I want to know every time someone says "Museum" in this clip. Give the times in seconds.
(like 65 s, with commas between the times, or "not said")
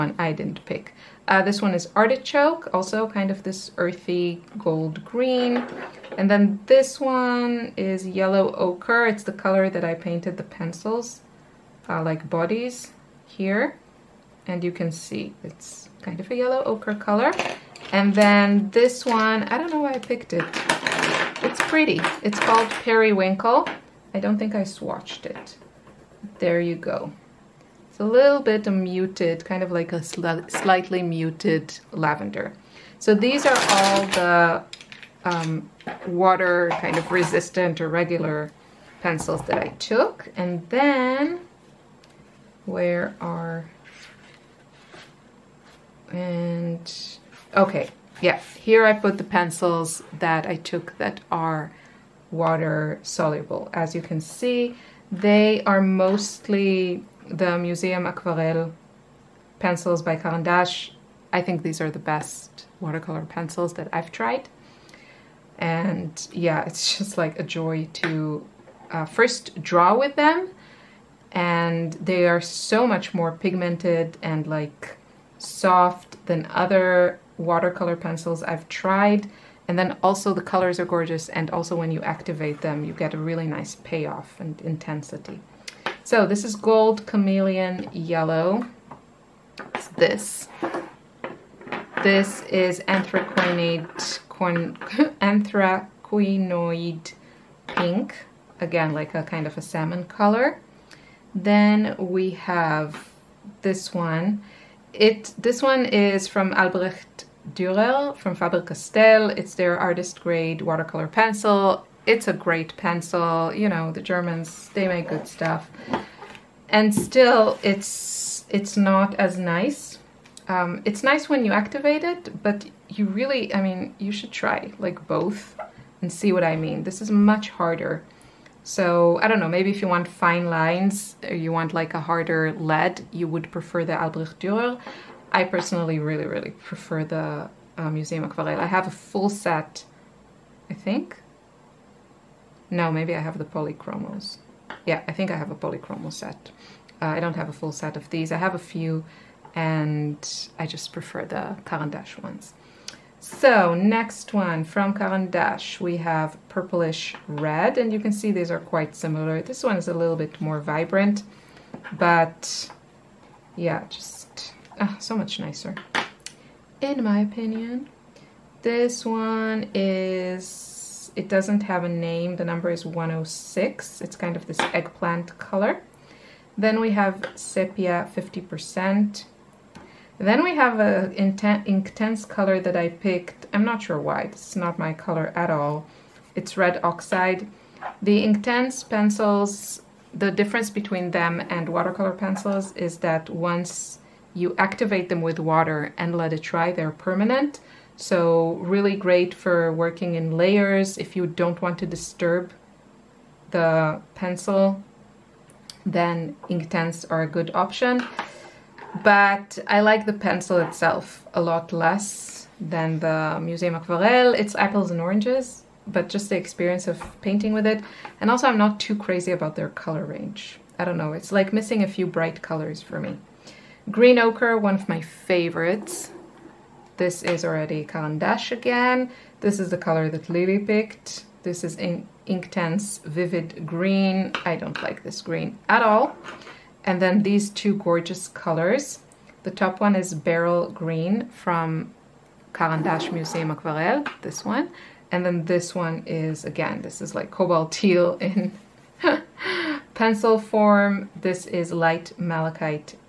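57 s, 137 s, 213 s, 243 s.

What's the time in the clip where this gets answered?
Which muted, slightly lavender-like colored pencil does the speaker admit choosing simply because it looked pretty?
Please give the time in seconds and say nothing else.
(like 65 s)
22 s.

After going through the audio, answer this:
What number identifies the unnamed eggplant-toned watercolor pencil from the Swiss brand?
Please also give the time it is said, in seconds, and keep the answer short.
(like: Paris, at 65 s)
106, at 172 s.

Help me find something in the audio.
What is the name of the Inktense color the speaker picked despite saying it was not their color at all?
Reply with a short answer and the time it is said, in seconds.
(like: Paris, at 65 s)
red oxide, at 186 s.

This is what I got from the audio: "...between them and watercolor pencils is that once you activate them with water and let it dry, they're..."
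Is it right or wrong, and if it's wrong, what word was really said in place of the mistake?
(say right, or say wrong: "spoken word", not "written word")
right.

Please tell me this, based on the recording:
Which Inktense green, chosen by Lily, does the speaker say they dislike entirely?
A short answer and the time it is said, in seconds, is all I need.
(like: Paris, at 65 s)
Vivid Green, at 233 s.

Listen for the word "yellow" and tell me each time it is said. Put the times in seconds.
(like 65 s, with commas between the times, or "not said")
8 s, 16 s, 87 s.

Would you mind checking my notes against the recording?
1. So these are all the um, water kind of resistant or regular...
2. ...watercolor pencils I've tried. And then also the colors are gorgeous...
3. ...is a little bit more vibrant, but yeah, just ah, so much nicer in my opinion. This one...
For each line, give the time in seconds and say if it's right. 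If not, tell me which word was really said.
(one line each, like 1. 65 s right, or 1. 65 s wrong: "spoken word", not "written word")
1. 32 s right
2. 77 s right
3. 159 s right.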